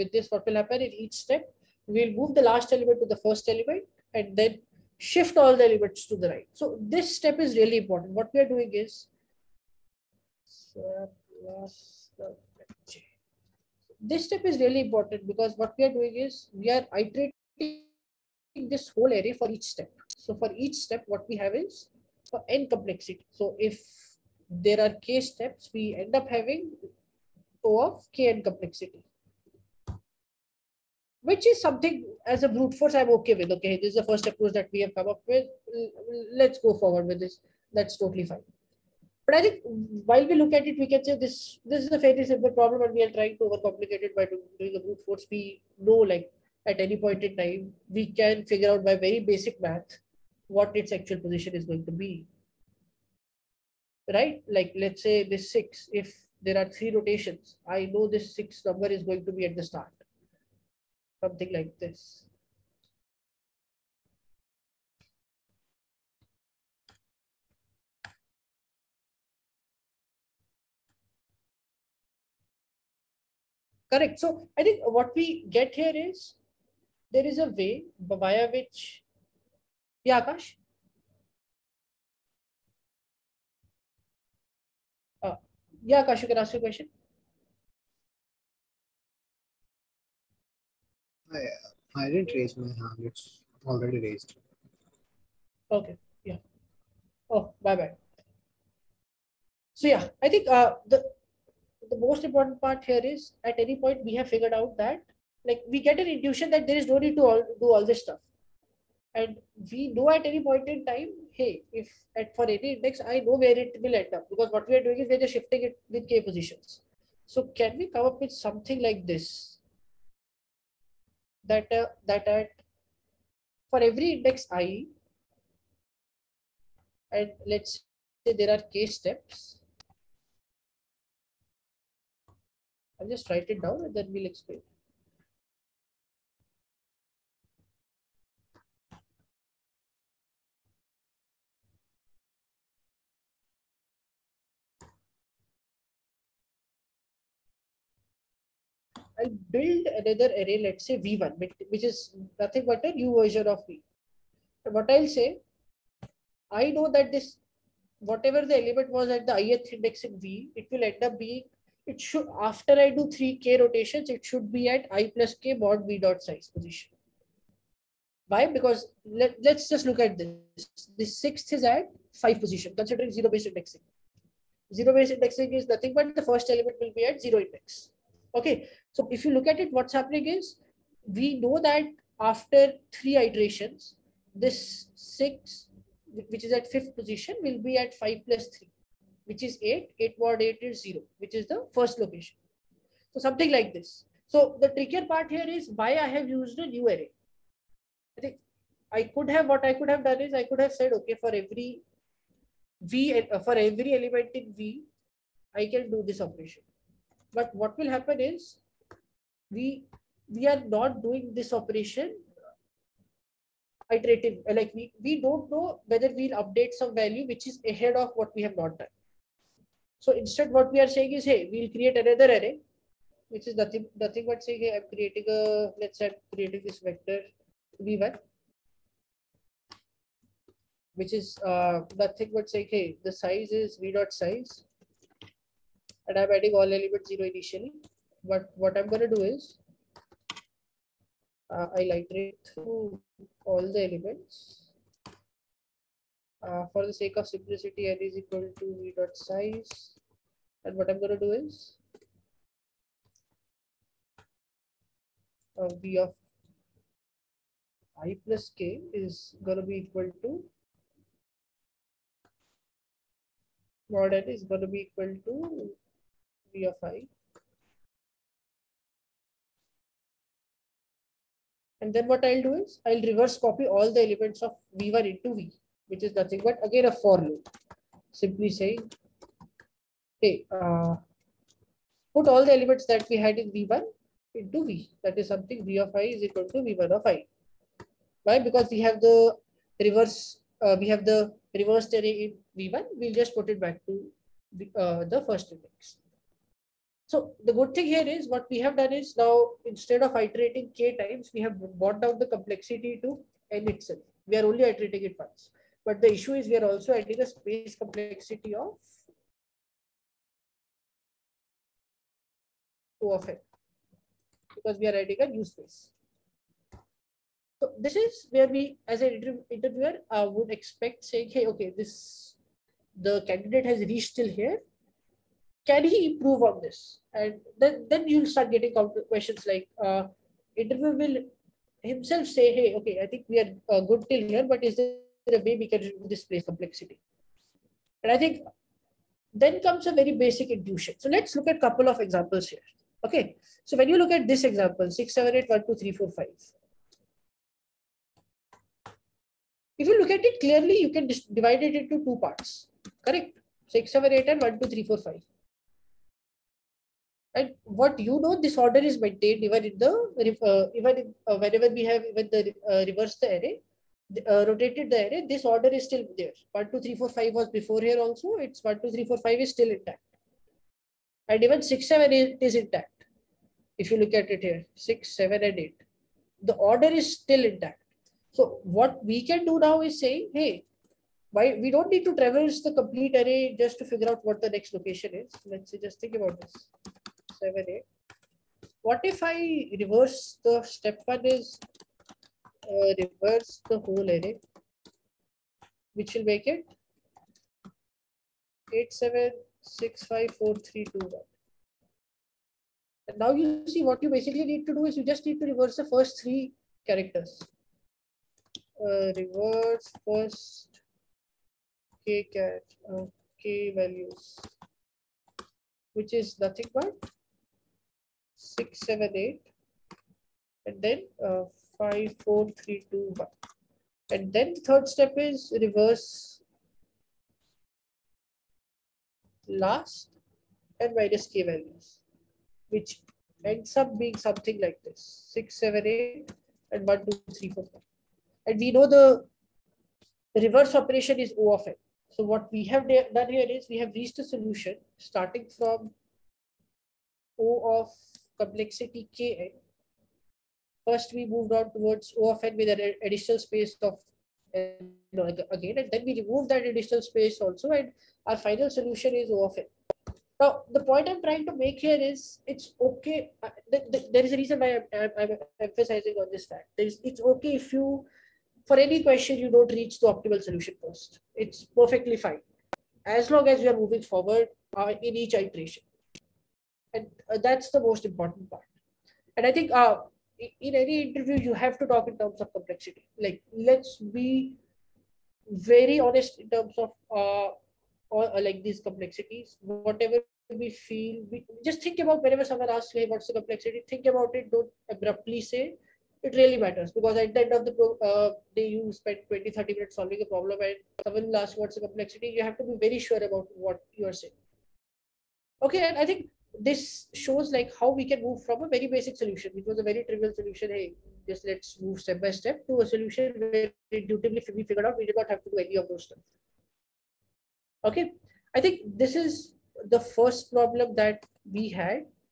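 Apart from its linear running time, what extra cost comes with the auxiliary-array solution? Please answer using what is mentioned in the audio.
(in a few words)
space complexity.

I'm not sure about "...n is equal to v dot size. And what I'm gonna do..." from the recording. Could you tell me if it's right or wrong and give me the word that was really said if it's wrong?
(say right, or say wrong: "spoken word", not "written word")
right.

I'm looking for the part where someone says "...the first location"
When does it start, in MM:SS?
03:11.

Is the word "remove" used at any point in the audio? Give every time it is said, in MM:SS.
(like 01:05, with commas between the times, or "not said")
07:36.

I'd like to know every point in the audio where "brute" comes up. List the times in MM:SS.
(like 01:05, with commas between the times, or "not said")
00:32, 00:44.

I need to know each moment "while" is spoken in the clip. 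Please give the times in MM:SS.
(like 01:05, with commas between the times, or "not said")
00:40.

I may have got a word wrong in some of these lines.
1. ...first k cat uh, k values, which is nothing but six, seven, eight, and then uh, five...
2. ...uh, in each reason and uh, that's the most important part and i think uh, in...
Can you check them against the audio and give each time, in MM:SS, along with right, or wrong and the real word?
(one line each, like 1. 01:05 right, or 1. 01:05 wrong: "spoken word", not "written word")
1. 06:50 right
2. 07:54 wrong: "iteration", not "reason".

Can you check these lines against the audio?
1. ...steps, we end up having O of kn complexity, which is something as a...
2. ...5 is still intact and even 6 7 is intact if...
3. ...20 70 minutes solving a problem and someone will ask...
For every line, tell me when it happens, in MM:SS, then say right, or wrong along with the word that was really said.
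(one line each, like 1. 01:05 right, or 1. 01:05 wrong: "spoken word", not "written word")
1. 00:25 right
2. 06:09 right
3. 08:19 wrong: "30", not "70".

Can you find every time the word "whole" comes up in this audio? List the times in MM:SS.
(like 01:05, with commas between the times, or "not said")
00:18, 06:33.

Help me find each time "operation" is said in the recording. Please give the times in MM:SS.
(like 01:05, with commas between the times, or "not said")
03:26, 03:31, 07:20.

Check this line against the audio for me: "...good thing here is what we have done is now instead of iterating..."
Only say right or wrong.
right.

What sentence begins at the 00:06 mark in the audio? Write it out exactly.
So this step is really important.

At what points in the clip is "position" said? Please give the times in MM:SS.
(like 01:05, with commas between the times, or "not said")
00:51, 01:56, 02:46, 02:52, 03:06.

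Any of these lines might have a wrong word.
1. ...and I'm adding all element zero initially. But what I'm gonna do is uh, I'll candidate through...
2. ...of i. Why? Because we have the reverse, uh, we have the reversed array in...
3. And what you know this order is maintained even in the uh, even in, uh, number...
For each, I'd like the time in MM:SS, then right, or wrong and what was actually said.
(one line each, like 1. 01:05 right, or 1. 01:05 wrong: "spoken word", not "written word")
1. 03:56 wrong: "iterate", not "candidate"
2. 04:46 right
3. 05:57 wrong: "whenever", not "number".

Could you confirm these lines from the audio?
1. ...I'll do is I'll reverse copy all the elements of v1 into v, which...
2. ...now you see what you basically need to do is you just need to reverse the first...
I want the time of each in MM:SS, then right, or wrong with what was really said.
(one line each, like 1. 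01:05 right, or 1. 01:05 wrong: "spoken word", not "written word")
1. 04:32 right
2. 06:43 right.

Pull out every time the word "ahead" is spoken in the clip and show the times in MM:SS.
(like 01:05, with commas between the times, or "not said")
03:37.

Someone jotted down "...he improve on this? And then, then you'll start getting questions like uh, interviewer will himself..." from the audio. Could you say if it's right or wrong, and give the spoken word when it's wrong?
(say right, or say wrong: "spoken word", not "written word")
right.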